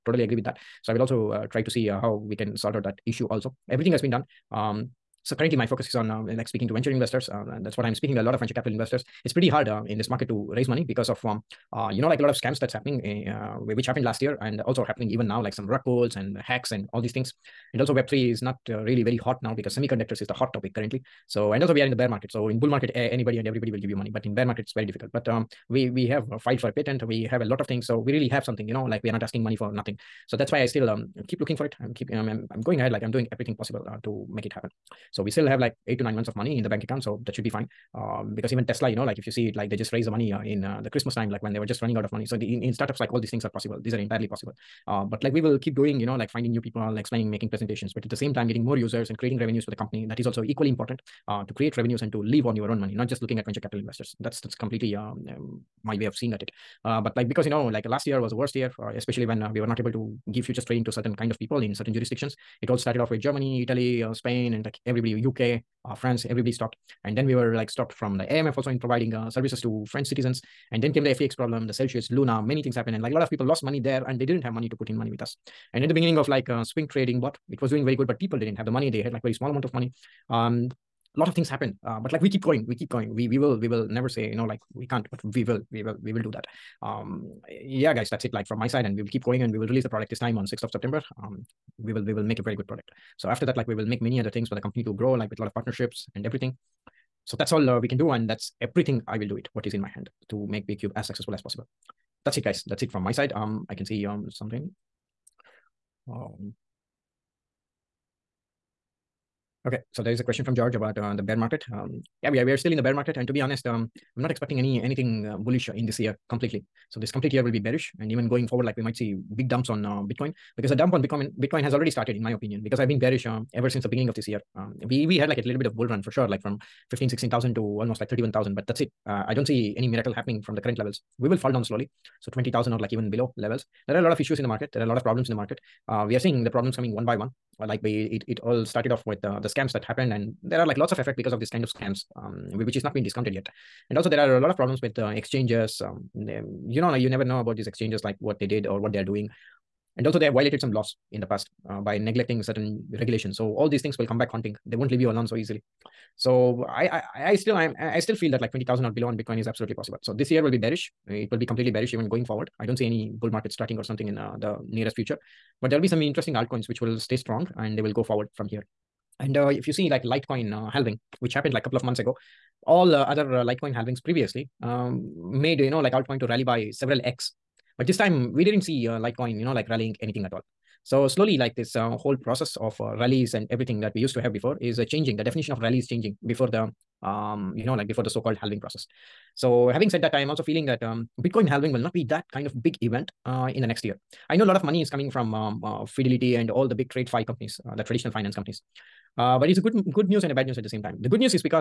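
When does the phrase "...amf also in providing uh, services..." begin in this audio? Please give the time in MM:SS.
01:08.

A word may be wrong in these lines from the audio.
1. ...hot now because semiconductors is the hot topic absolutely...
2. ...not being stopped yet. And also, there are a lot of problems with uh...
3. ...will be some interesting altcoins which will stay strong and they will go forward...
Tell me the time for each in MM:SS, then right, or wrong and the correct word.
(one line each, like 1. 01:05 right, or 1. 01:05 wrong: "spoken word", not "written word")
1. 00:19 wrong: "currently", not "absolutely"
2. 02:22 wrong: "discounted", not "stopped"
3. 02:45 right.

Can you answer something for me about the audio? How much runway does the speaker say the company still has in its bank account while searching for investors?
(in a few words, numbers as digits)
8 to 9 months.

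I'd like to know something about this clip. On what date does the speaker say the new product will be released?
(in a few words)
6th of September.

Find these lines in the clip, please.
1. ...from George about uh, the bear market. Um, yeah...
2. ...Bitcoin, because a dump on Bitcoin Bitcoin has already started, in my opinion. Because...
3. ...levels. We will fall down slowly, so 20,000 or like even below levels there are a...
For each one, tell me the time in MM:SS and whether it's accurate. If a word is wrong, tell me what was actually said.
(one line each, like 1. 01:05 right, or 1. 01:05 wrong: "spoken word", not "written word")
1. 01:50 right
2. 02:00 right
3. 02:10 right.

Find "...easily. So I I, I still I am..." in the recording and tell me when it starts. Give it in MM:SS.
02:35.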